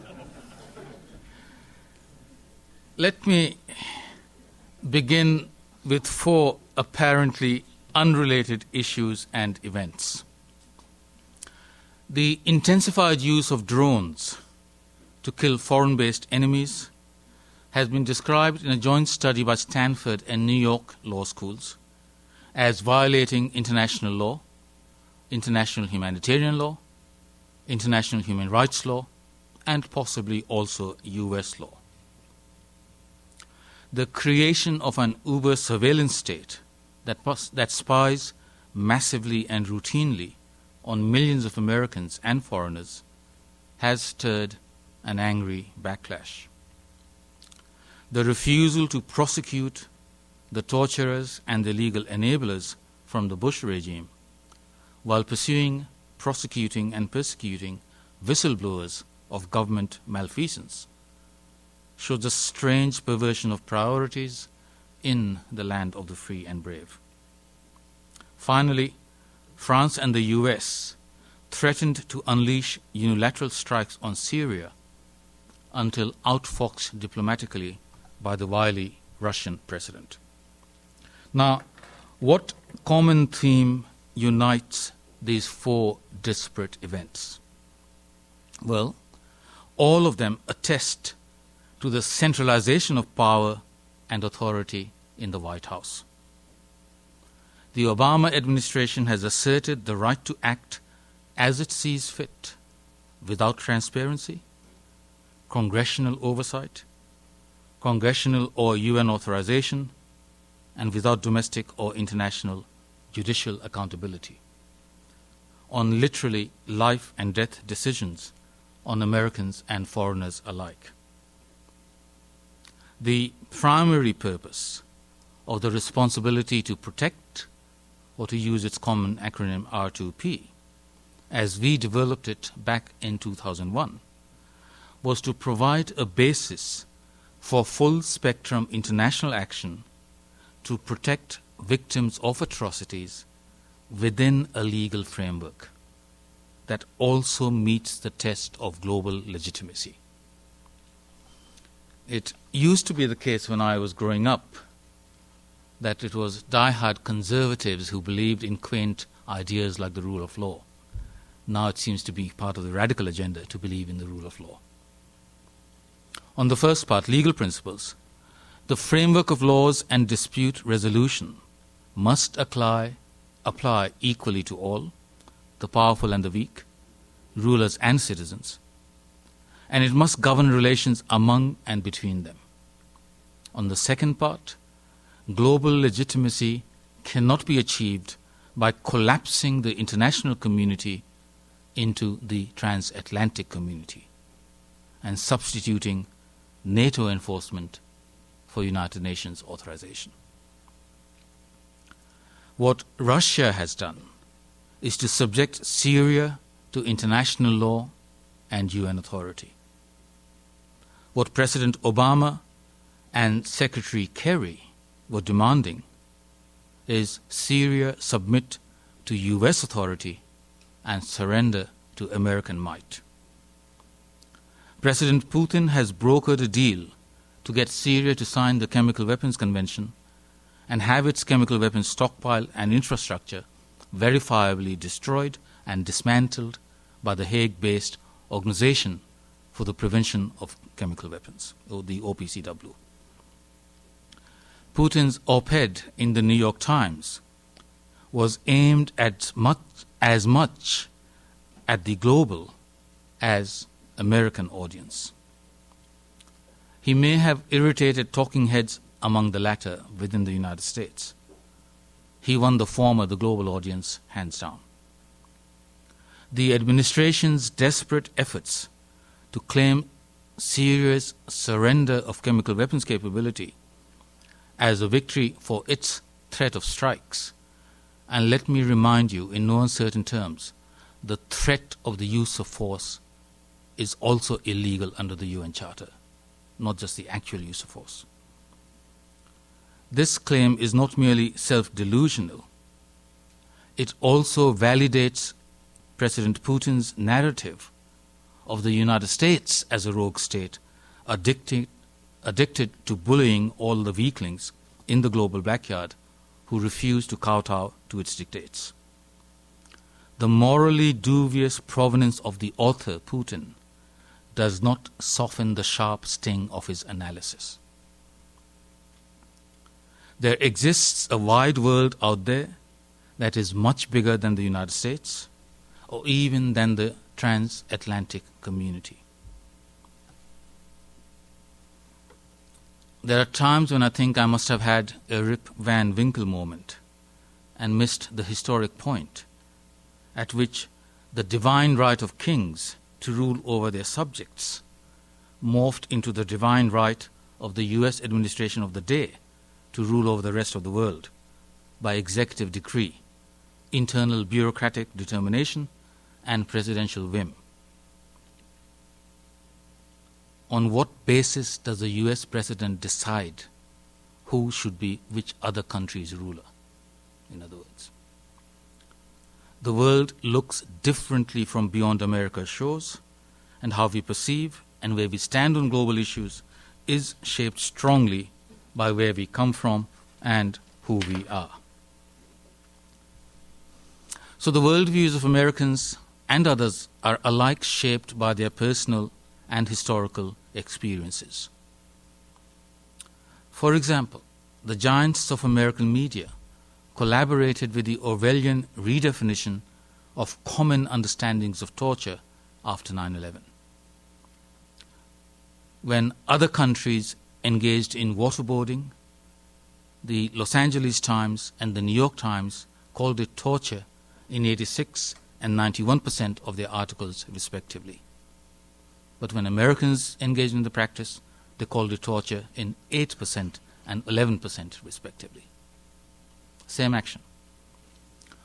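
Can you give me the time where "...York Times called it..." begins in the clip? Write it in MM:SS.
06:51.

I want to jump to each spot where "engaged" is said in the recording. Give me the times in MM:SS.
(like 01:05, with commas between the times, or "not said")
06:47, 07:00.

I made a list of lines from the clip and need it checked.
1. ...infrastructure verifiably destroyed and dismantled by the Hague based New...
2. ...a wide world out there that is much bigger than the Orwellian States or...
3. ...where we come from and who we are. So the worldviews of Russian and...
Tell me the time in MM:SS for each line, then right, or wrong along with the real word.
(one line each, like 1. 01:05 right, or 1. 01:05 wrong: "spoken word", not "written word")
1. 03:52 wrong: "Organization", not "New"
2. 05:21 wrong: "United", not "Orwellian"
3. 06:18 wrong: "Americans", not "Russian".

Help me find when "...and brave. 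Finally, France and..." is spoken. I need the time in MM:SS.
01:06.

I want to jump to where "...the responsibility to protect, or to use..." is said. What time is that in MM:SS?
02:05.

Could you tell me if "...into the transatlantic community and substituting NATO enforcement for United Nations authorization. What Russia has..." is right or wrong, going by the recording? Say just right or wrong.
right.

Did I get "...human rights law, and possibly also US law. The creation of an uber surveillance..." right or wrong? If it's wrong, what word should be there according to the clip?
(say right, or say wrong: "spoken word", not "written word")
right.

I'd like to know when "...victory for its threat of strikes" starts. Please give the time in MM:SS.
04:34.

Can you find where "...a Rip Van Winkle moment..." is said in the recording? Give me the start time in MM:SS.
05:35.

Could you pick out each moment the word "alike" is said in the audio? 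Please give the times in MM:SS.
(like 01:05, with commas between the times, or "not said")
02:00, 06:27.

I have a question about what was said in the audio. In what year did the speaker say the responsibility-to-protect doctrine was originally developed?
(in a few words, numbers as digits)
2001.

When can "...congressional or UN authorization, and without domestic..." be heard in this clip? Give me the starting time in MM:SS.
01:47.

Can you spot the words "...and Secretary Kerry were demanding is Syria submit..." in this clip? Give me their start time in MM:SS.
03:33.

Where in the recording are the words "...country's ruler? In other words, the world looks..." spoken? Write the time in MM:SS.
06:05.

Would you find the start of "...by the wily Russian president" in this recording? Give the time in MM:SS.
01:18.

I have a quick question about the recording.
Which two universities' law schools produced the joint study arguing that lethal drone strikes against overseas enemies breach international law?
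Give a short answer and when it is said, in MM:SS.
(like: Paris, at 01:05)
Stanford and New York, at 00:19.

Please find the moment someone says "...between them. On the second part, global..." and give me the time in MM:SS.
03:01.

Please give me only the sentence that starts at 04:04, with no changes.
Putin's op ed in the New York Times was aimed at much, as much at the global as American audience.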